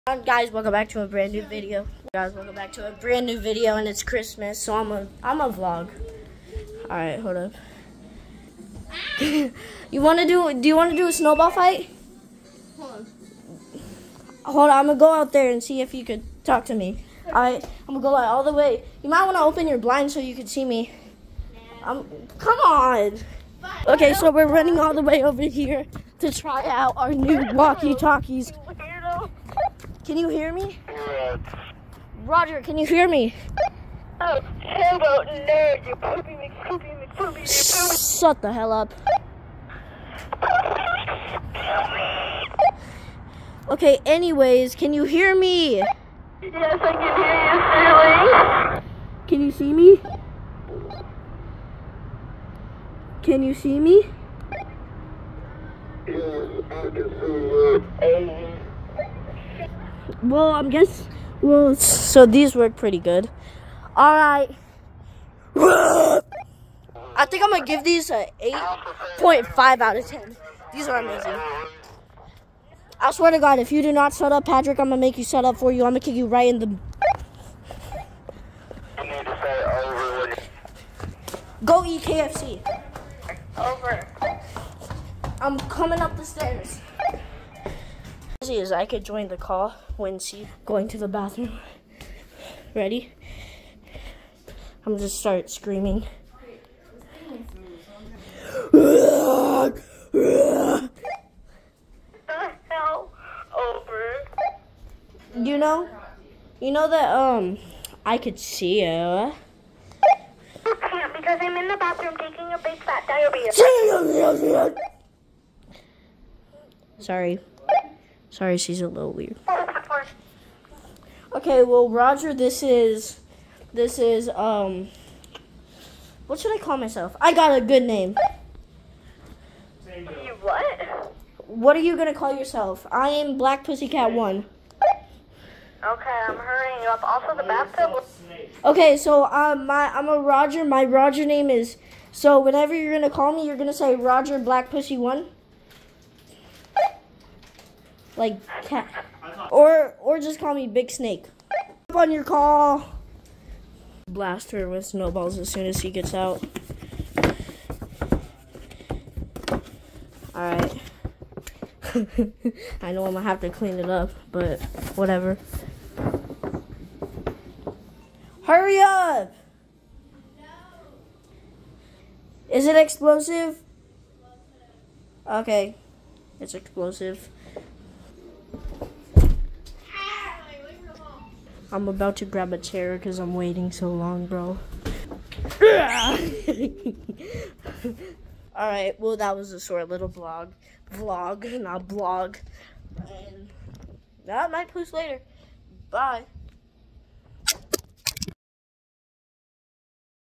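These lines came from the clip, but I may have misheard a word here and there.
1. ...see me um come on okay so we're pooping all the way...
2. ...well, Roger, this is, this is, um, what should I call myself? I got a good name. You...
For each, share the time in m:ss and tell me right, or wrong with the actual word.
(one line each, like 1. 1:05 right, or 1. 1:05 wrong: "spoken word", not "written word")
1. 0:20 wrong: "running", not "pooping"
2. 2:01 right.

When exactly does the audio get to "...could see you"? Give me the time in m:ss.
1:48.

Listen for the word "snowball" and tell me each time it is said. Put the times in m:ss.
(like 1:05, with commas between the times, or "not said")
0:11, 2:34.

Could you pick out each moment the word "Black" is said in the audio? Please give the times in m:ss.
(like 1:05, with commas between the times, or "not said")
2:13, 2:24.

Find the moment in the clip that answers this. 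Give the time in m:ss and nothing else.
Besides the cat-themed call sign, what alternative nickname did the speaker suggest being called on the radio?
2:30.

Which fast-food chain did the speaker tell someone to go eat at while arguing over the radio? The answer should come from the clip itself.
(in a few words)
KFC.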